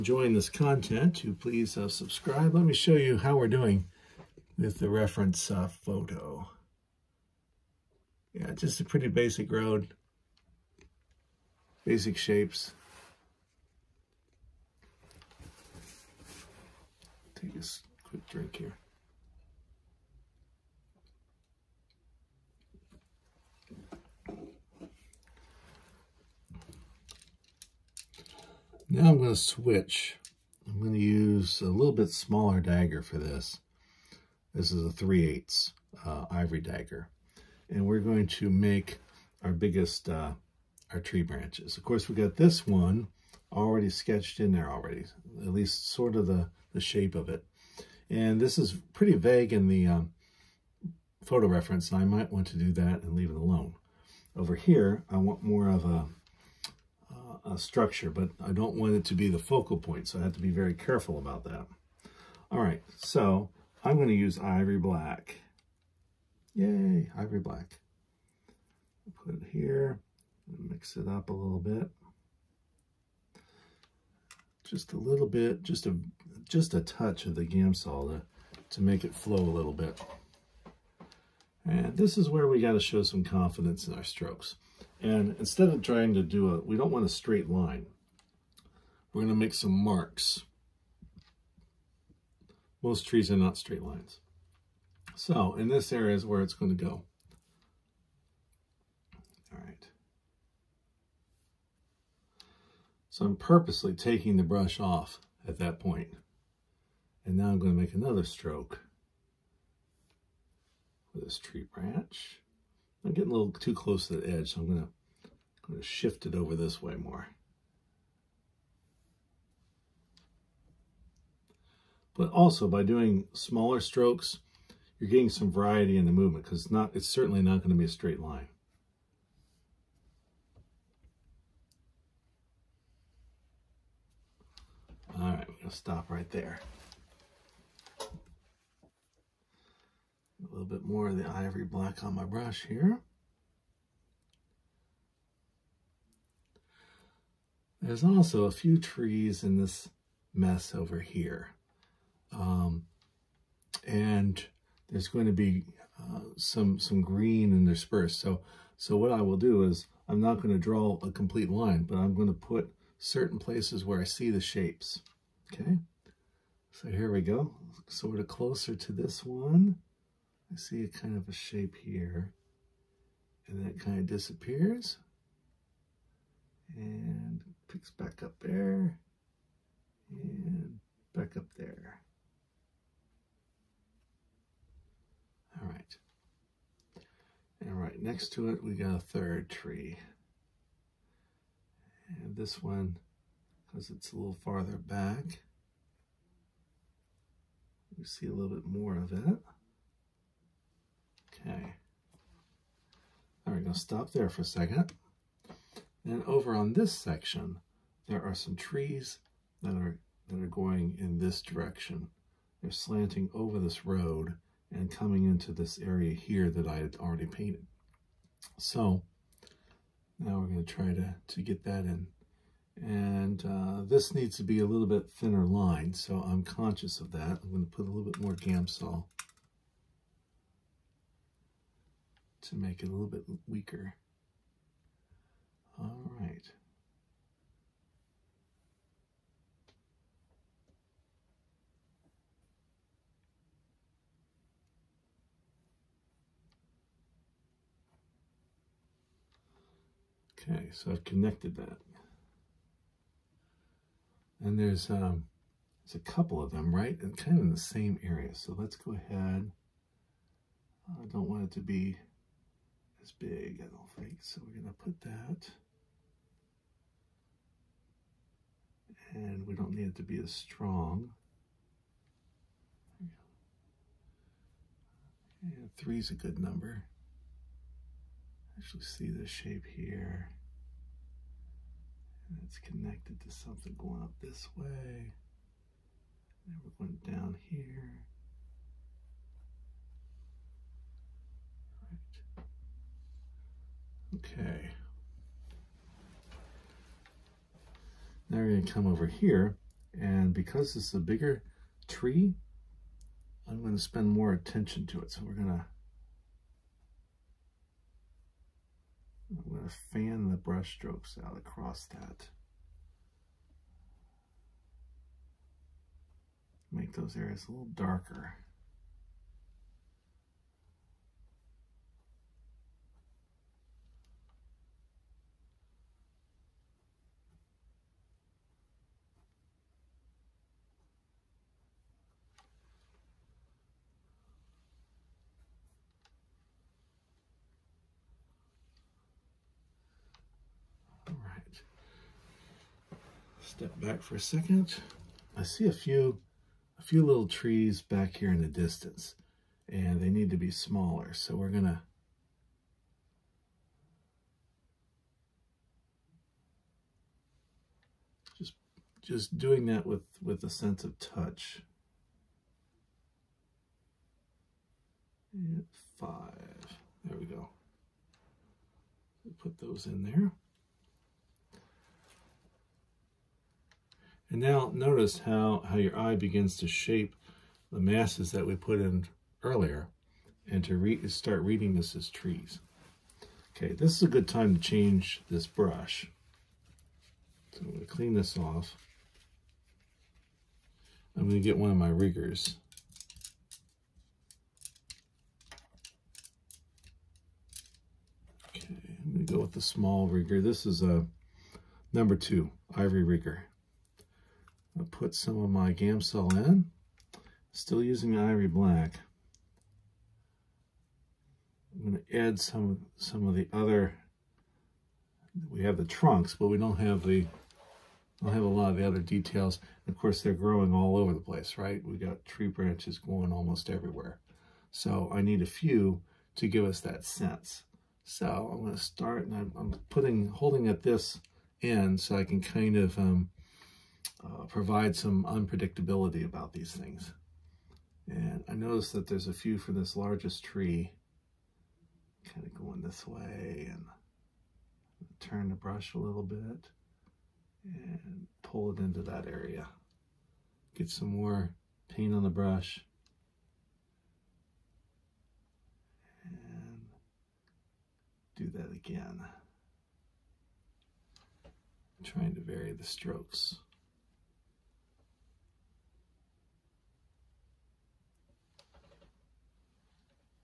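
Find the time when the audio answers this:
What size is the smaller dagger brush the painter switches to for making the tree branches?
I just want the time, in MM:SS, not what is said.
00:34.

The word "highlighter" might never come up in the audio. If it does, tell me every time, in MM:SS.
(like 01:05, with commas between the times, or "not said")
not said.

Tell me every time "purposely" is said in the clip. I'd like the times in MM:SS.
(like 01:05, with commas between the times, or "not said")
01:43.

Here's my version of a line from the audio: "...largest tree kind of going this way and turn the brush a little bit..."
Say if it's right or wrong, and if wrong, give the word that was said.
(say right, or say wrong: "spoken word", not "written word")
right.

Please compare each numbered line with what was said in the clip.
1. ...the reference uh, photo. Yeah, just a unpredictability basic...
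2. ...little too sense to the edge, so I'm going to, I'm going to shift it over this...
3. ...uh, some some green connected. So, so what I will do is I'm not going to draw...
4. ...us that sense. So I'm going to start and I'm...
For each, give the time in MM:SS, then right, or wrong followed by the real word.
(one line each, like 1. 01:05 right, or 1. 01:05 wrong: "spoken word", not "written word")
1. 00:04 wrong: "pretty", not "unpredictability"
2. 01:53 wrong: "close", not "sense"
3. 02:35 wrong: "interspersed", not "connected"
4. 07:06 right.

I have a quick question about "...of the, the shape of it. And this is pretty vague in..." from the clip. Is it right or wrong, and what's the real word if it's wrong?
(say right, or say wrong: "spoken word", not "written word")
right.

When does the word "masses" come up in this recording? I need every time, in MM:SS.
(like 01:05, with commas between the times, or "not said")
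06:17.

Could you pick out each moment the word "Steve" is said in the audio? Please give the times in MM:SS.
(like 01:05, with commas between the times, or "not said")
not said.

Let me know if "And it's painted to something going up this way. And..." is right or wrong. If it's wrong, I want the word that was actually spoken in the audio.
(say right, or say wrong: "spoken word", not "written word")
wrong: "connected", not "painted".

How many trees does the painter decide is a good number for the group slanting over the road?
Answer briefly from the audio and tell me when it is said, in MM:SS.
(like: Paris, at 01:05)
3, at 04:35.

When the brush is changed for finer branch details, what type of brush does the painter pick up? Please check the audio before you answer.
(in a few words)
small rigger.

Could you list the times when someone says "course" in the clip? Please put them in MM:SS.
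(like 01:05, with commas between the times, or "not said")
00:41, 06:59.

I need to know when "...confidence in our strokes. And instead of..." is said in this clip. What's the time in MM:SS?
01:23.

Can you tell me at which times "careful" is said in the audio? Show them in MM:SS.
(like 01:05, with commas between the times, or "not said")
01:00.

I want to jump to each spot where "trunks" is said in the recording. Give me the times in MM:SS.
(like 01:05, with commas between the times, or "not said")
06:55.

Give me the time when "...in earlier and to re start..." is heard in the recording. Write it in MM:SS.
06:18.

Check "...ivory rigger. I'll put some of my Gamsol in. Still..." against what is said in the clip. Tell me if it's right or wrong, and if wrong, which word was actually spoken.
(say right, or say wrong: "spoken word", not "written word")
right.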